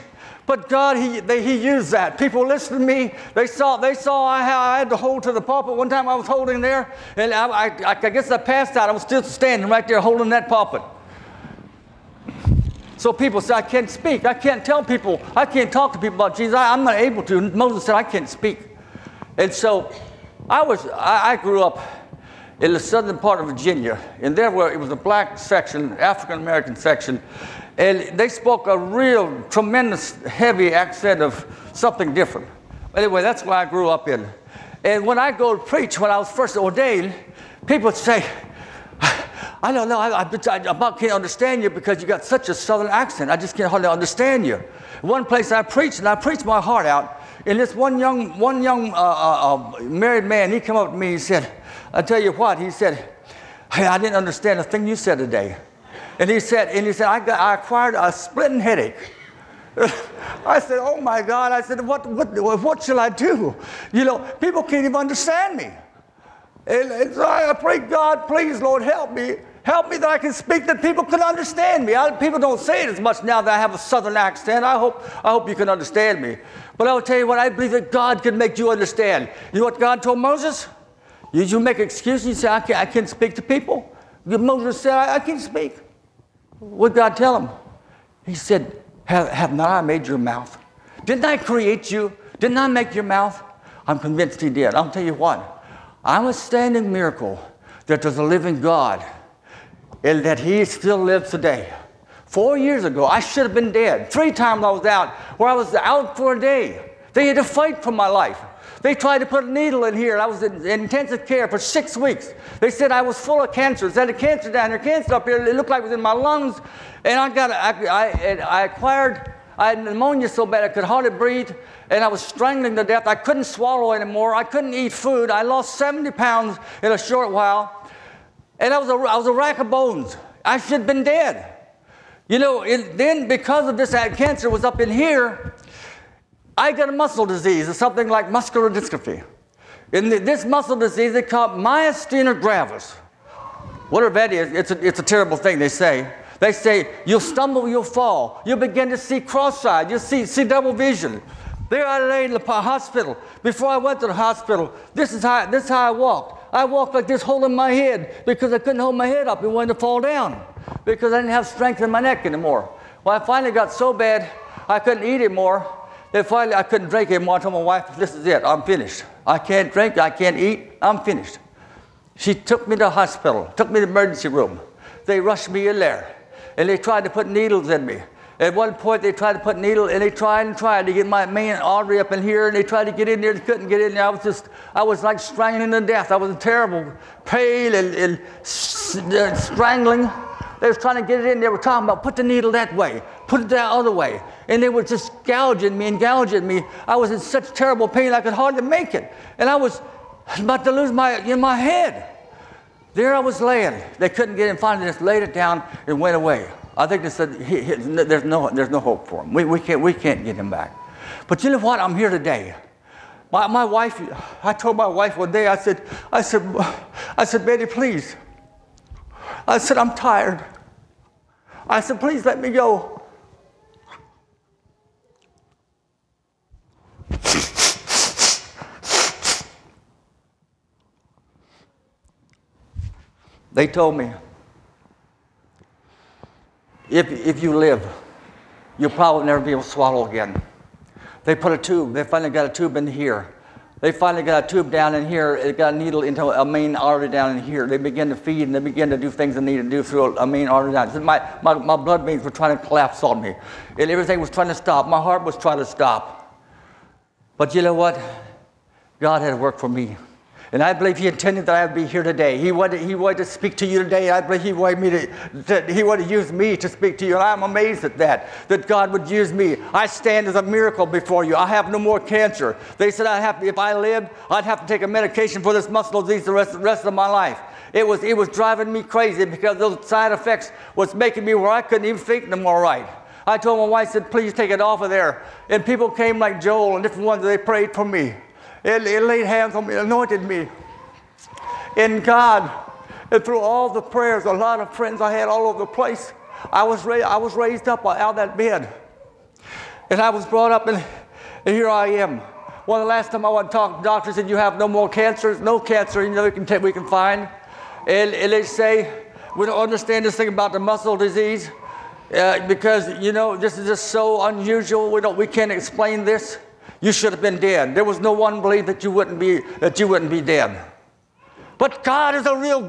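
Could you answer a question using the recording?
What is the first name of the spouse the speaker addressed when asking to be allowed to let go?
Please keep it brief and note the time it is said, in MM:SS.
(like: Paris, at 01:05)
Betty, at 03:37.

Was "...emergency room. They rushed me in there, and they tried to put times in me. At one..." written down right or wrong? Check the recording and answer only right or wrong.
wrong.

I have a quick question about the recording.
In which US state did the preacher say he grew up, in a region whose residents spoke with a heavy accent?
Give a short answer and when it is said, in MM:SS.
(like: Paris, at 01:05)
Virginia, at 00:23.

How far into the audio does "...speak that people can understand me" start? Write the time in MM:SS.
01:10.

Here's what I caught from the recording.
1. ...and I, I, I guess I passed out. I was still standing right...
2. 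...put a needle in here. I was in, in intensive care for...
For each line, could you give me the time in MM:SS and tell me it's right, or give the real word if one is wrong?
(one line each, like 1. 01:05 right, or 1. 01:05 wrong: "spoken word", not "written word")
1. 00:07 right
2. 01:49 right.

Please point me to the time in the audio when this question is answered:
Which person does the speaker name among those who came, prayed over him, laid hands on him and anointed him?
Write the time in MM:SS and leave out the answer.
04:46.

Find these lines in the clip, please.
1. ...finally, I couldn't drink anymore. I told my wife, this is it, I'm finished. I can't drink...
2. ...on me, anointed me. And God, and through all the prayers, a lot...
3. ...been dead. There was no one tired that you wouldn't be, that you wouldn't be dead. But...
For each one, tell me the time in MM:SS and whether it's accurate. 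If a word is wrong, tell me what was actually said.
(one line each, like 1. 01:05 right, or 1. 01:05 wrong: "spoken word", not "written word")
1. 02:46 right
2. 04:49 right
3. 05:17 wrong: "believed", not "tired".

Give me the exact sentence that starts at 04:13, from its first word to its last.
And everything was trying to stop.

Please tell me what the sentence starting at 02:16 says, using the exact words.
I get a muscle disease, or something like muscular dystrophy.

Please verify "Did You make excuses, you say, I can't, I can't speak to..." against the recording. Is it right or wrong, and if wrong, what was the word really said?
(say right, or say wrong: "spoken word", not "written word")
right.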